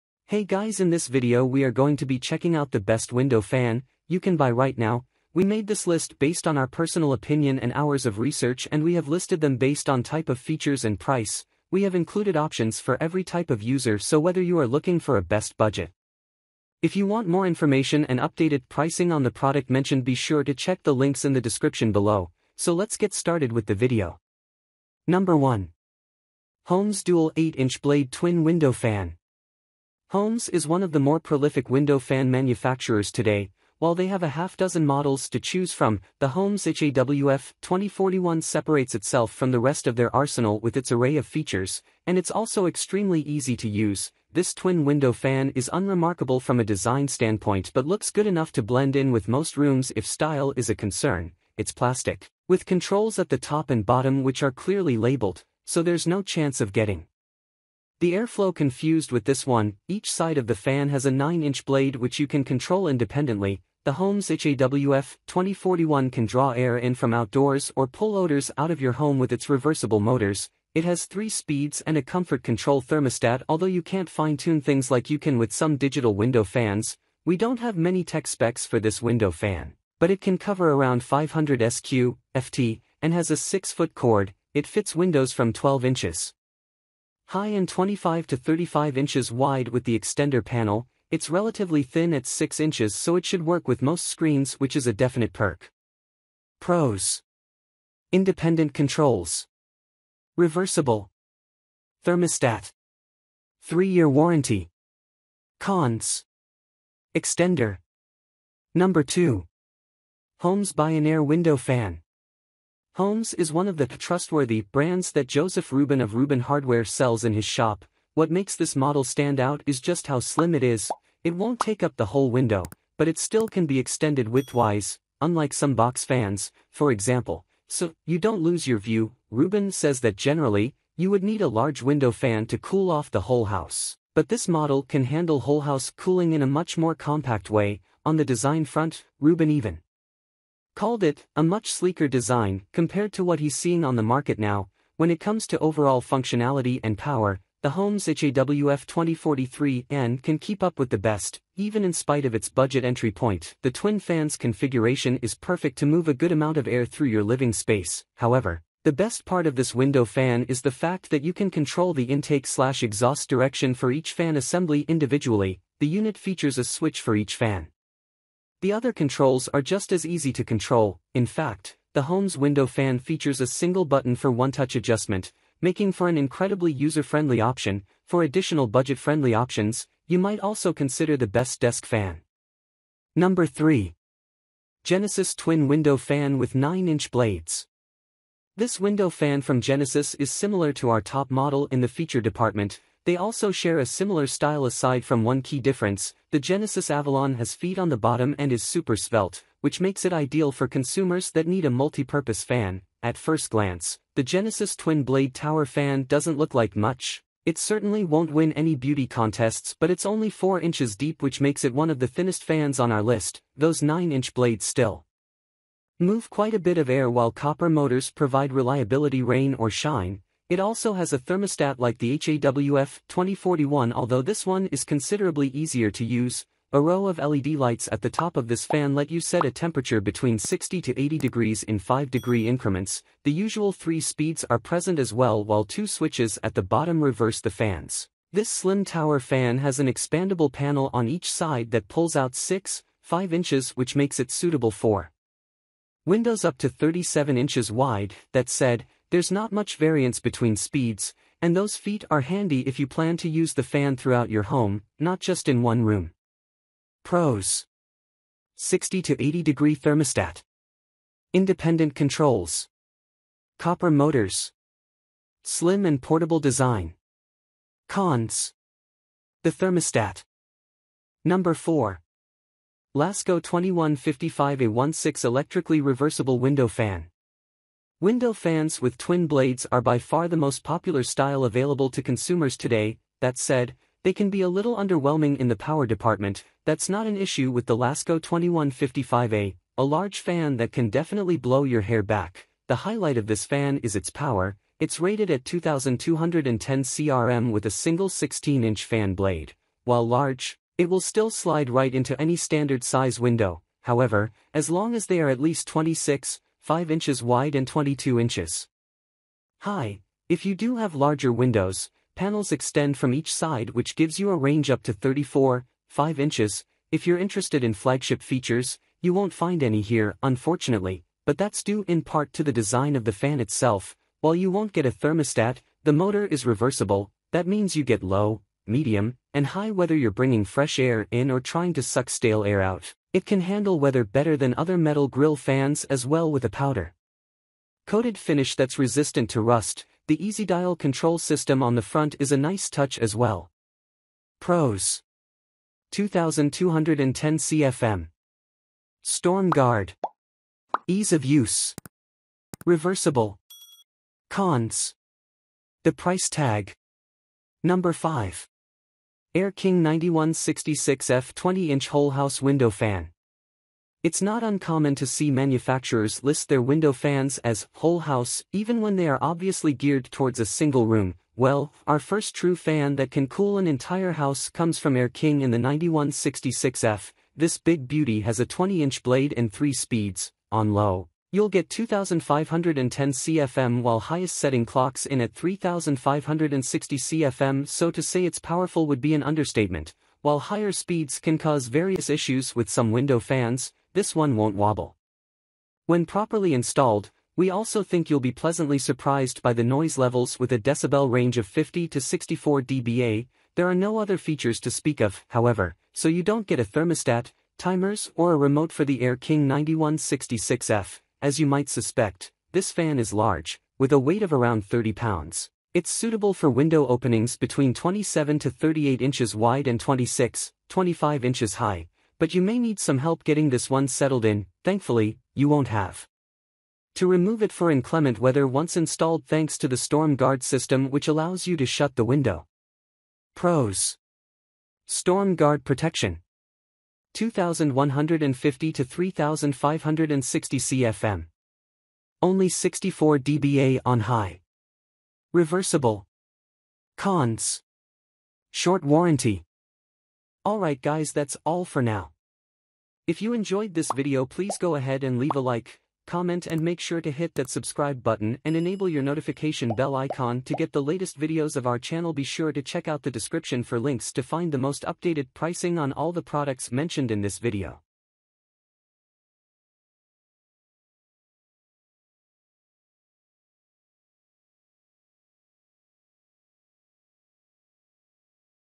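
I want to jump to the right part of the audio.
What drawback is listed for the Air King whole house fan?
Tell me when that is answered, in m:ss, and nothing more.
7:28.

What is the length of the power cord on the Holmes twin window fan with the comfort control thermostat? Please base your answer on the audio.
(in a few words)
6-foot.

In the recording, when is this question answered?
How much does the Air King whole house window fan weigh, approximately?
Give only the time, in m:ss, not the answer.
6:54.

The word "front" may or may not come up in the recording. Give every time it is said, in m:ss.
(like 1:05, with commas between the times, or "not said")
2:18, 5:41.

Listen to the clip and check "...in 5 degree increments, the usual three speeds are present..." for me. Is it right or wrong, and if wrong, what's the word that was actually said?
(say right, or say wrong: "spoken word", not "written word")
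right.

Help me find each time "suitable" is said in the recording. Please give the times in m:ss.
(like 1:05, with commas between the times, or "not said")
4:04, 6:55.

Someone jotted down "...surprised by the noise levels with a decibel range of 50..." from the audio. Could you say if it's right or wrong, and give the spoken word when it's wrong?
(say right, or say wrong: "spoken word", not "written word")
right.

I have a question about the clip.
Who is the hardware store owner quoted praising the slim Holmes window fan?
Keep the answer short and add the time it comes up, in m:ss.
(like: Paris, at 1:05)
Joseph Rubin, at 1:55.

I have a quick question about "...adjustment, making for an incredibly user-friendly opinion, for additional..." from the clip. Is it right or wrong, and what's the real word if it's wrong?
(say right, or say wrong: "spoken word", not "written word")
wrong: "option", not "opinion".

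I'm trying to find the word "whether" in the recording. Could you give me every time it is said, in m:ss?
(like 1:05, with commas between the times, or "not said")
0:14, 5:29.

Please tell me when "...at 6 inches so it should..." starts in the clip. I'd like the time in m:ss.
1:32.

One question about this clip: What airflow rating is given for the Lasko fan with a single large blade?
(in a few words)
2210 CFM.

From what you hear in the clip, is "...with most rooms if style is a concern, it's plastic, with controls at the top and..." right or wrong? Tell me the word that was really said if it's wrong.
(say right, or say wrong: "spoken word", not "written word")
right.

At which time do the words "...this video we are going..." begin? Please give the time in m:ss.
0:00.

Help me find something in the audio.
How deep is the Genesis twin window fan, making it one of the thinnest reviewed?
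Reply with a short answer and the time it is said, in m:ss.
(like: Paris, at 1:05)
4 inches, at 3:30.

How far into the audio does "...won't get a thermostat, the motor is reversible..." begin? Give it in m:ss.
5:24.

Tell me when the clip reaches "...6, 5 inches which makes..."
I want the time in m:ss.
4:02.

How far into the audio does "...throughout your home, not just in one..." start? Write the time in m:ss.
4:13.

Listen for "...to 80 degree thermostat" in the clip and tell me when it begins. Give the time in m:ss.
4:19.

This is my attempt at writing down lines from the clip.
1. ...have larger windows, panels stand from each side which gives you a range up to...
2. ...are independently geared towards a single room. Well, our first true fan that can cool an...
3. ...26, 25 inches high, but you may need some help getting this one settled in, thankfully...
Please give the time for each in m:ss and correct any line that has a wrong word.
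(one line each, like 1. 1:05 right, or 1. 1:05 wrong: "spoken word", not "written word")
1. 5:10 wrong: "extend", not "stand"
2. 6:09 wrong: "obviously", not "independently"
3. 6:59 right.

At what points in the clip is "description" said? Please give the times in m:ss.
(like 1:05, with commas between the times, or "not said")
0:21, 7:43.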